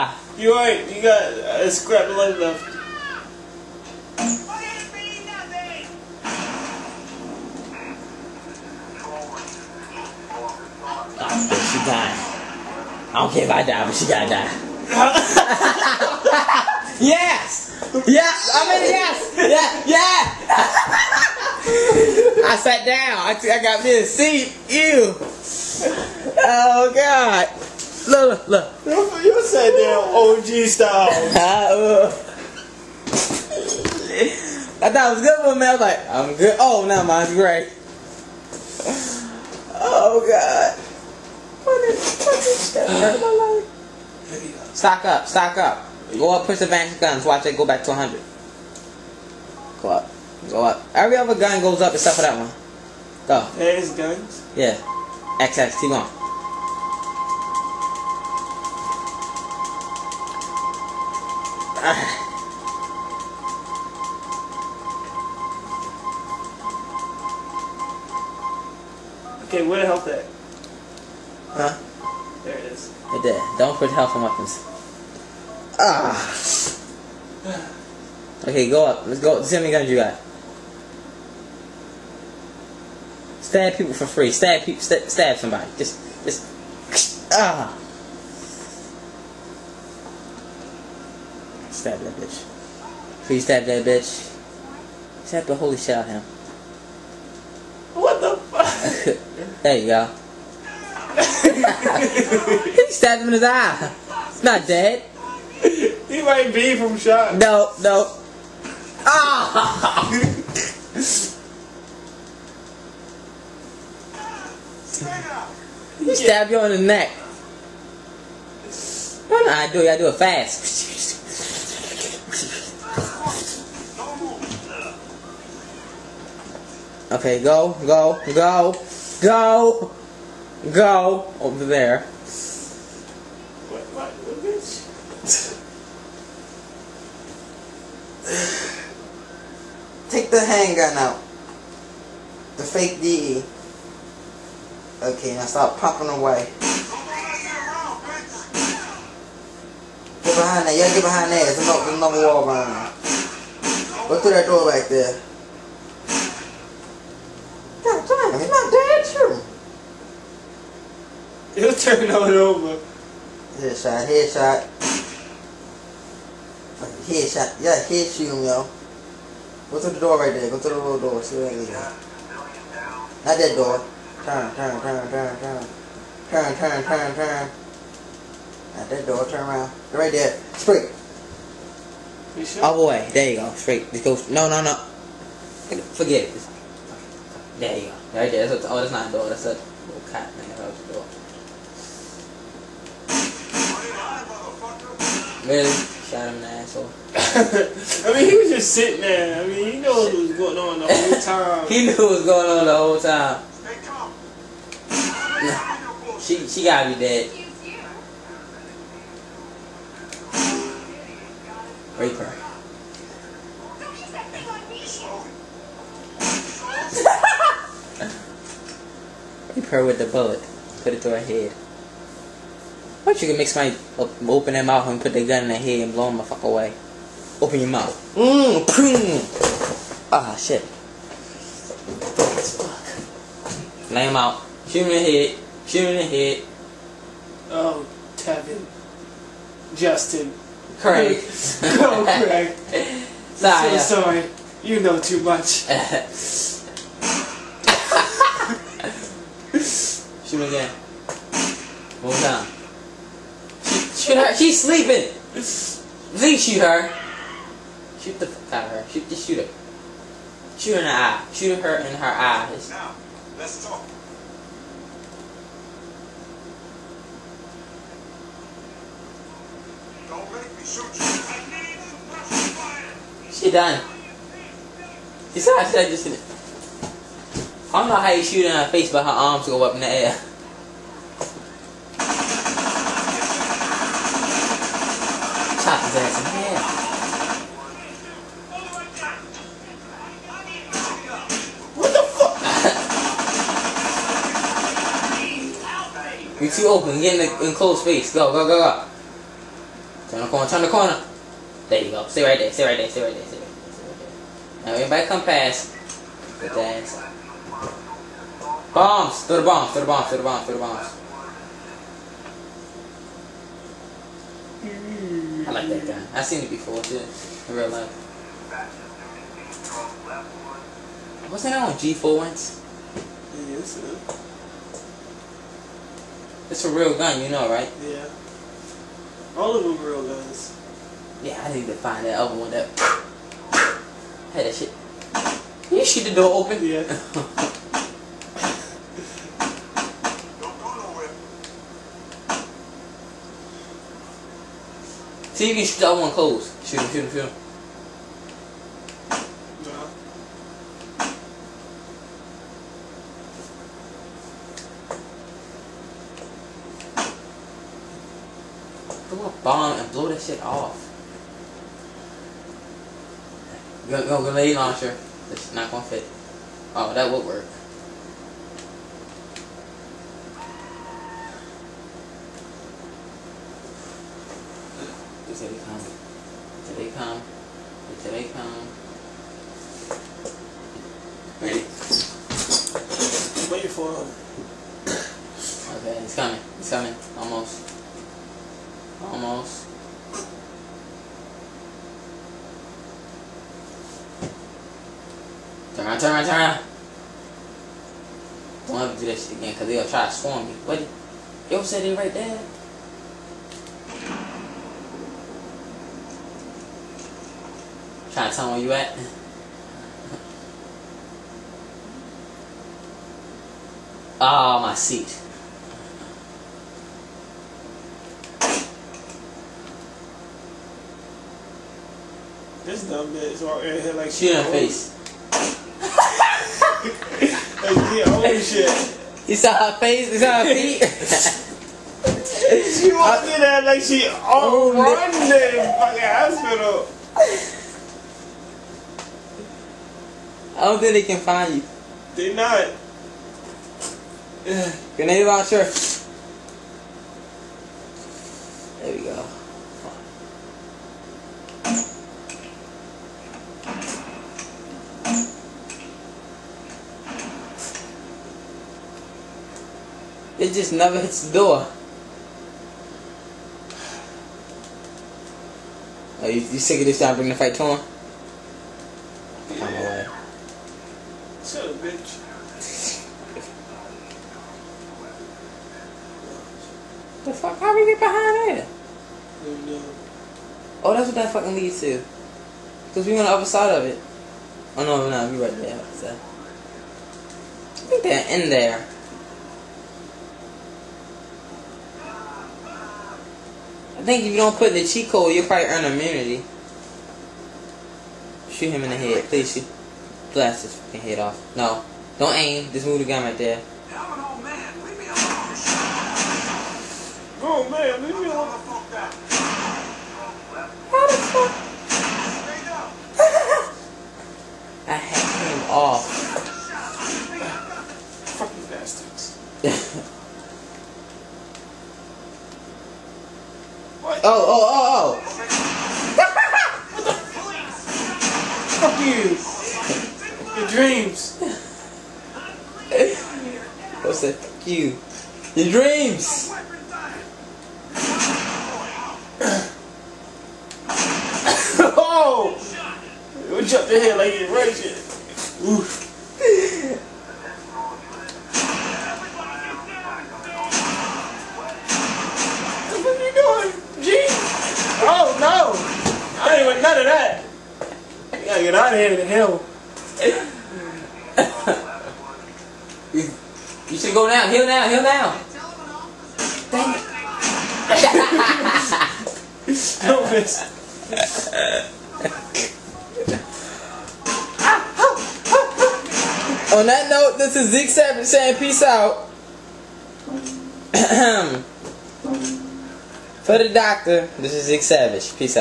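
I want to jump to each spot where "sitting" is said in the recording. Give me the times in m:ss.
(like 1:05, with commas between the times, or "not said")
3:18.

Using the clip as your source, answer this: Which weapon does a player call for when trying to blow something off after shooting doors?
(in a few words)
grenade launcher.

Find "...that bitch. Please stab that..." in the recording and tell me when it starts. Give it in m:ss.
1:32.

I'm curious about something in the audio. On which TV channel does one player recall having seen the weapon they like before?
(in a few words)
G4.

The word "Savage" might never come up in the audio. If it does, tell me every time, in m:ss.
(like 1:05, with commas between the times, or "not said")
9:37, 9:44.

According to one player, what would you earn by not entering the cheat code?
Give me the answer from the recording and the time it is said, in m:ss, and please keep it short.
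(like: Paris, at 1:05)
immunity, at 8:15.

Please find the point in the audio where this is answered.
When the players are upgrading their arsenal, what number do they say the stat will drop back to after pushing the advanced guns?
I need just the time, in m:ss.
0:47.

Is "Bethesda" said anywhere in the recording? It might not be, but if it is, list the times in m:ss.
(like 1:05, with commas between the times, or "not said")
not said.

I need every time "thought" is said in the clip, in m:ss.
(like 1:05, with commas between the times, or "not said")
0:34.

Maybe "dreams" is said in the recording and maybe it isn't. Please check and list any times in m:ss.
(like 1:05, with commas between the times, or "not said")
8:50, 8:55.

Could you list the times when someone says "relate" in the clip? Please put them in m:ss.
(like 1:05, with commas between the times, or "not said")
not said.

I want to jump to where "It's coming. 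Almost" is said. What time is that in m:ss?
6:26.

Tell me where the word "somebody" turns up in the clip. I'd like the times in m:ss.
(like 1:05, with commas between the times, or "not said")
1:25, 3:43.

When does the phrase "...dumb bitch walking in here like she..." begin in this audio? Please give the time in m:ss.
7:02.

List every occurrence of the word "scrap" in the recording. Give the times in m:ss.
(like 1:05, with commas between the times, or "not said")
0:01.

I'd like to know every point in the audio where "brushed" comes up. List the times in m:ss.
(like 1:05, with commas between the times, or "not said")
not said.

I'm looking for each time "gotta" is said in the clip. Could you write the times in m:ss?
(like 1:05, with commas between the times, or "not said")
0:14, 3:26.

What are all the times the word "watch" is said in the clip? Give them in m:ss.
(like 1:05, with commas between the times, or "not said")
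0:47, 7:25.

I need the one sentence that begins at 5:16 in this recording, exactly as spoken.
I've seen it before too in real life.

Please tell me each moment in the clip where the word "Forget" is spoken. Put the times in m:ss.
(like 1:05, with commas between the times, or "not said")
3:05.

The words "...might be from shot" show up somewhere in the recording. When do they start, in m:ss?
1:46.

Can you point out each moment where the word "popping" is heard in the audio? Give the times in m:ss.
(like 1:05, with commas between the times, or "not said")
2:25.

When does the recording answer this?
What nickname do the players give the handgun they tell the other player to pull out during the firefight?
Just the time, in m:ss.
2:22.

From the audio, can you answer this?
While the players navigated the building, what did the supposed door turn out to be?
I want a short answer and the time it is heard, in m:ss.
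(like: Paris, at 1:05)
a little cat, at 3:09.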